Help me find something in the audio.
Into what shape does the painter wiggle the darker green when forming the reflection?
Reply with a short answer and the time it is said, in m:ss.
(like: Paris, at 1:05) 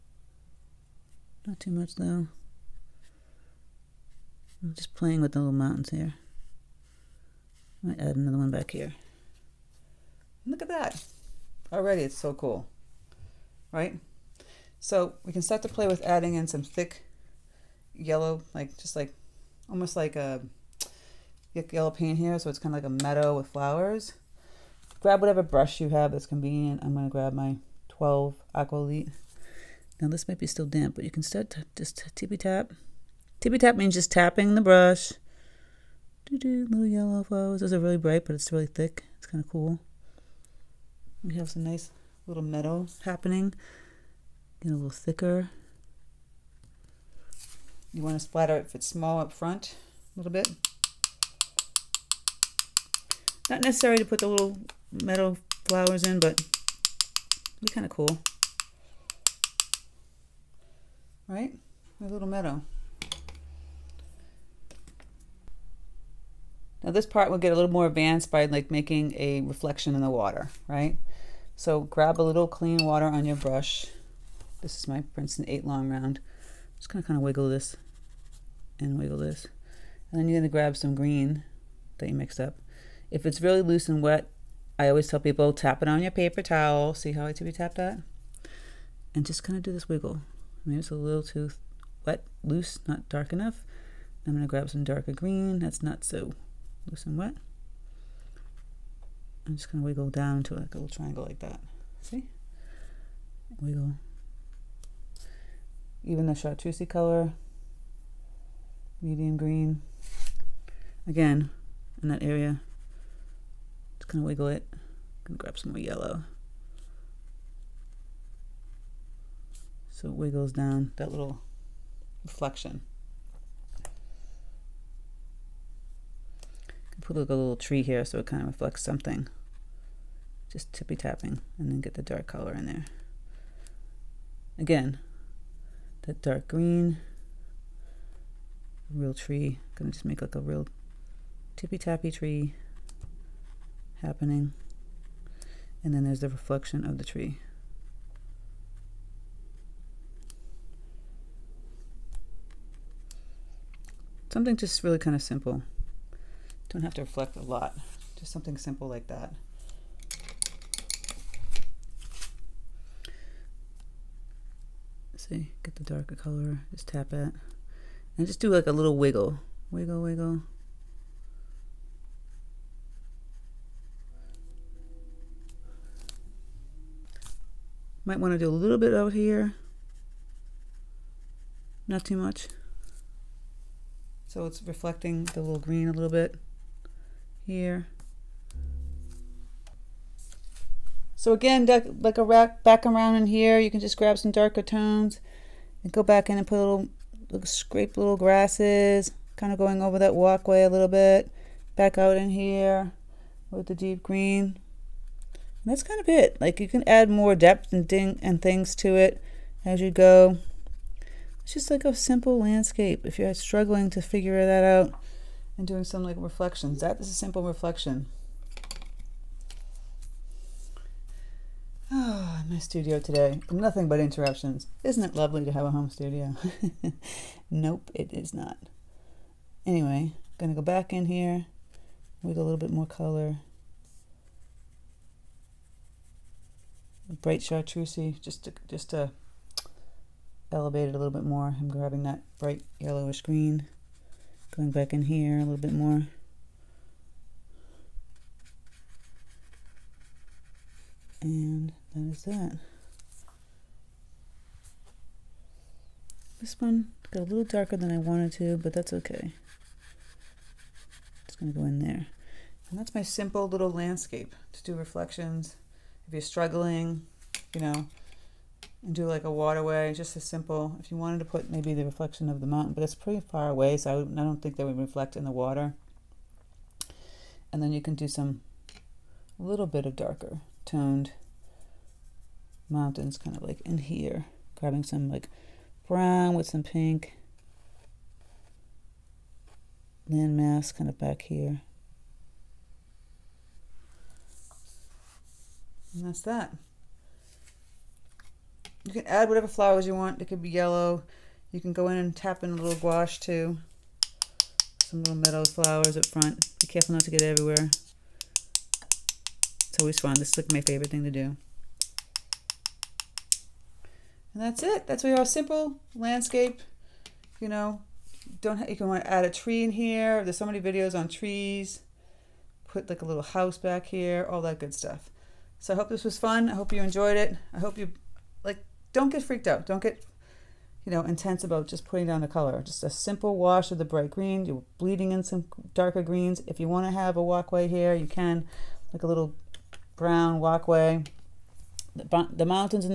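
triangle, at 1:40.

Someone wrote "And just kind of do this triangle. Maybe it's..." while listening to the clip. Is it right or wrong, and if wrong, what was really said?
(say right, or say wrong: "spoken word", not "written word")
wrong: "wiggle", not "triangle".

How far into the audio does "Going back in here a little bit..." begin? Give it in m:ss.
4:04.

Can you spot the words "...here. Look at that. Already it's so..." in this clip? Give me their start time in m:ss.
0:08.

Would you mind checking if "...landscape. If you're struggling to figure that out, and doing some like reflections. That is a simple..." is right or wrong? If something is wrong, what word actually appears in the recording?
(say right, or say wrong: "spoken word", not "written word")
right.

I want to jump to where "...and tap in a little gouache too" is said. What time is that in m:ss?
5:01.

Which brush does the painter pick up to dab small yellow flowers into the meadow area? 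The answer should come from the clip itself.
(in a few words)
12 Aqualite.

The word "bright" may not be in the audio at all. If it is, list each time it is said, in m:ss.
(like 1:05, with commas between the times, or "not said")
0:37, 3:57, 4:02, 5:33.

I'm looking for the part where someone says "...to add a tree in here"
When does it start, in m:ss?
5:19.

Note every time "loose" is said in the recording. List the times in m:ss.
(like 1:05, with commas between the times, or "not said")
1:23, 1:32, 1:36.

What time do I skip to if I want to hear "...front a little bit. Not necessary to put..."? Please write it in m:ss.
0:49.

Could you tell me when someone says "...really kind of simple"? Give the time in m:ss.
2:34.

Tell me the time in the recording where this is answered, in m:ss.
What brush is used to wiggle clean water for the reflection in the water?
1:15.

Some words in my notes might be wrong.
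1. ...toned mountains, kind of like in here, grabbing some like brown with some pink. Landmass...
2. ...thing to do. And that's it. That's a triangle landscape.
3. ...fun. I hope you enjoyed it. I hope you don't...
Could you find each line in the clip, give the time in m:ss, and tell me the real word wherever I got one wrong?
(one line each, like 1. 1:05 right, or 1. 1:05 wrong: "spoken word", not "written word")
1. 4:40 right
2. 5:10 wrong: "simple", not "triangle"
3. 5:26 right.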